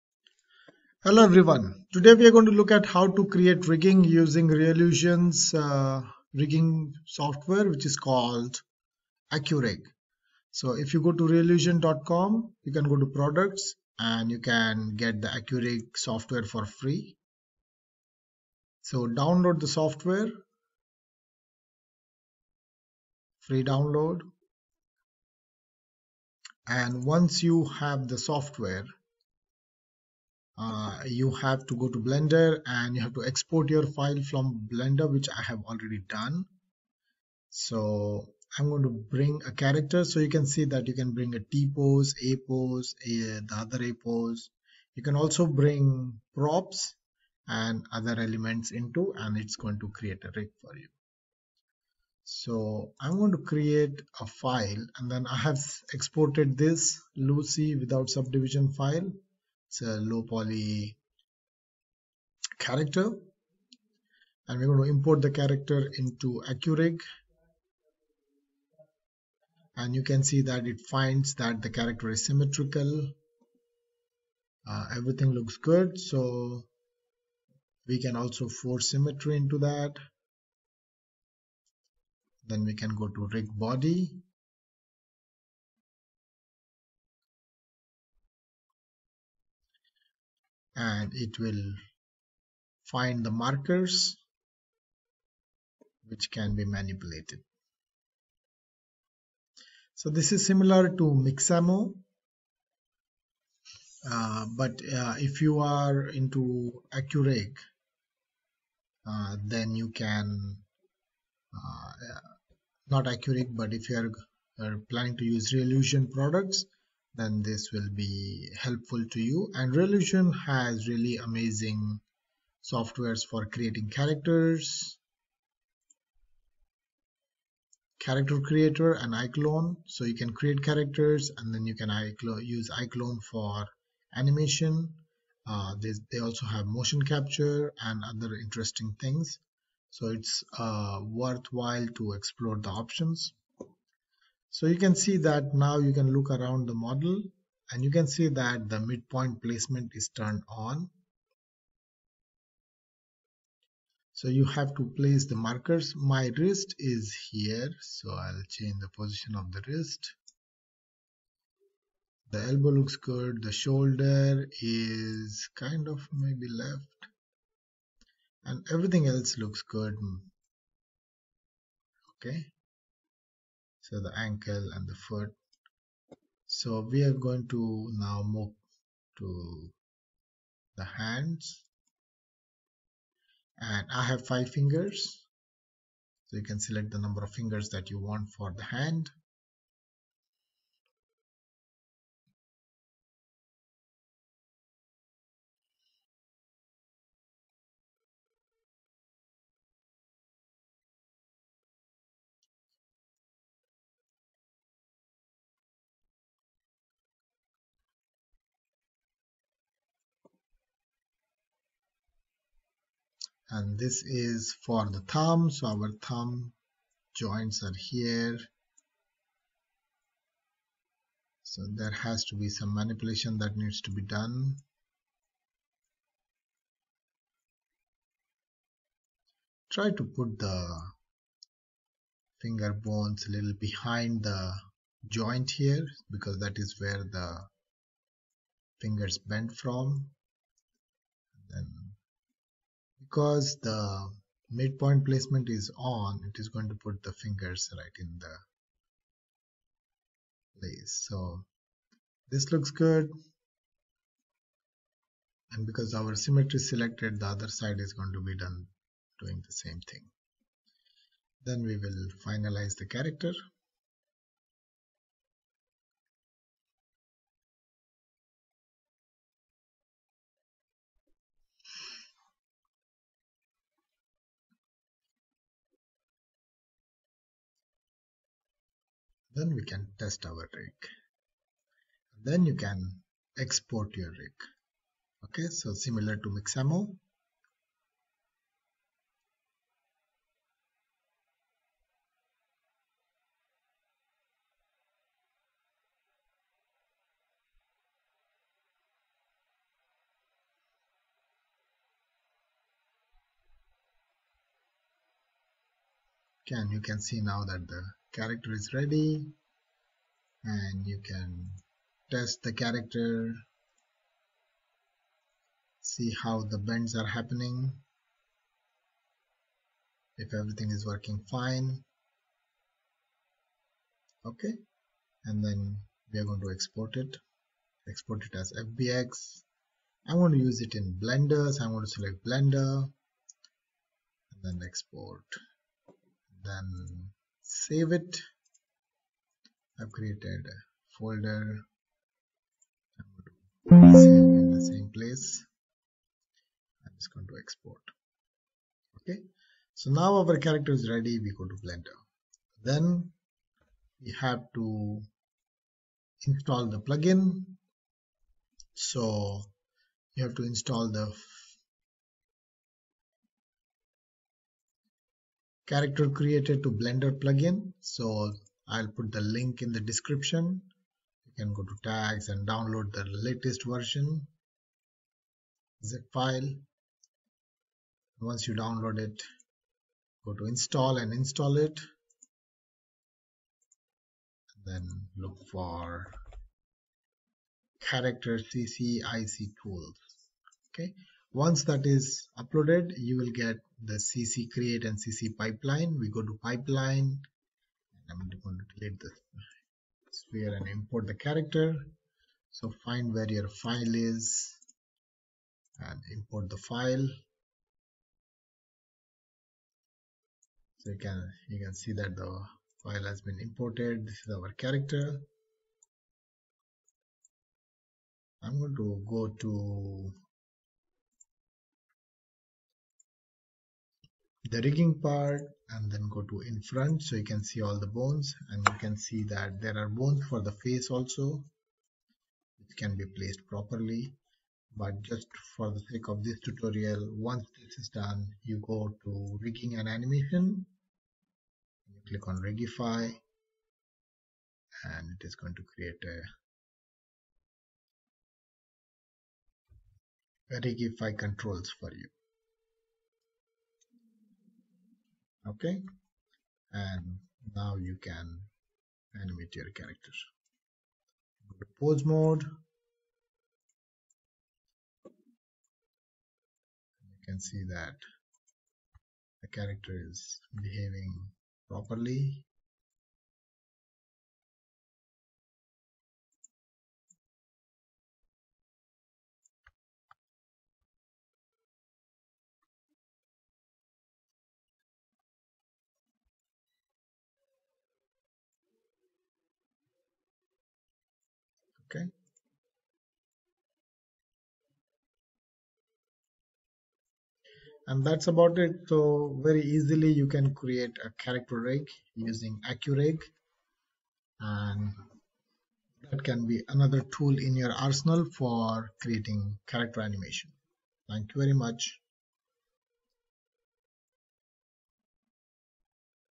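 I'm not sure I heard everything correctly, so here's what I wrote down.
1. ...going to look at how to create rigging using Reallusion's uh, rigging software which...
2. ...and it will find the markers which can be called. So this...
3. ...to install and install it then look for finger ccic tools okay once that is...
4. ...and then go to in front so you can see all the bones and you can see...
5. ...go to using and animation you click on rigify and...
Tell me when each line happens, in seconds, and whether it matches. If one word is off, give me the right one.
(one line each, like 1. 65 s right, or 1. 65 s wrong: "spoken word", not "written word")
1. 2 s right
2. 90 s wrong: "manipulated", not "called"
3. 380 s wrong: "character", not "finger"
4. 425 s right
5. 438 s wrong: "rigging", not "using".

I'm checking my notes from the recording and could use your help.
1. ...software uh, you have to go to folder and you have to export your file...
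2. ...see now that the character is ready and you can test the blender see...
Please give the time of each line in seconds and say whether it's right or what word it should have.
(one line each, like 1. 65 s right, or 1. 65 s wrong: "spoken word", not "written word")
1. 28 s wrong: "blender", not "folder"
2. 306 s wrong: "character", not "blender".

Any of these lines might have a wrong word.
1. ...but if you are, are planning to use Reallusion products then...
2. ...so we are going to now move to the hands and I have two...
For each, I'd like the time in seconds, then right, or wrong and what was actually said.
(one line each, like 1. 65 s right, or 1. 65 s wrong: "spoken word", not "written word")
1. 113 s right
2. 176 s wrong: "five", not "two".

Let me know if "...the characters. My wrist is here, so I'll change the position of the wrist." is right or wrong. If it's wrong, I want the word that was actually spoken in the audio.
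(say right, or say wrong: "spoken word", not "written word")
wrong: "markers", not "characters".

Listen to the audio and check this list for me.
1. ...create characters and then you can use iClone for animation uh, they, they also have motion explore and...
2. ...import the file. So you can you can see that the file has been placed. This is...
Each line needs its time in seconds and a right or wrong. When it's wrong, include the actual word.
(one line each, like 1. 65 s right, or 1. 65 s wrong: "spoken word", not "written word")
1. 130 s wrong: "capture", not "explore"
2. 406 s wrong: "imported", not "placed".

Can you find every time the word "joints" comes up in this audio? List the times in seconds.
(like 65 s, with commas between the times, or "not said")
217 s, 235 s.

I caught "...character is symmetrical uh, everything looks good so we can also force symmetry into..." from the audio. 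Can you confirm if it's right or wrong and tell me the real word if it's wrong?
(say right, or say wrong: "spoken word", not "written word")
right.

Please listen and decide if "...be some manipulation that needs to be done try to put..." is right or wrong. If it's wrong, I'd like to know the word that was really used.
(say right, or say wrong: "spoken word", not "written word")
right.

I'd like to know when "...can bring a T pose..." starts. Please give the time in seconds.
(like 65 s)
40 s.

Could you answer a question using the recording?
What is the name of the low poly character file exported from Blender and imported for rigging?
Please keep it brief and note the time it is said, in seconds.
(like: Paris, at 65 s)
Lucy, at 57 s.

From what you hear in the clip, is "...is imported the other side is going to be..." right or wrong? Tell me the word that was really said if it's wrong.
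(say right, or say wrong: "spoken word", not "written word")
wrong: "selected", not "imported".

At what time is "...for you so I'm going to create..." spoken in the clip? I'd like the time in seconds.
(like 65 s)
50 s.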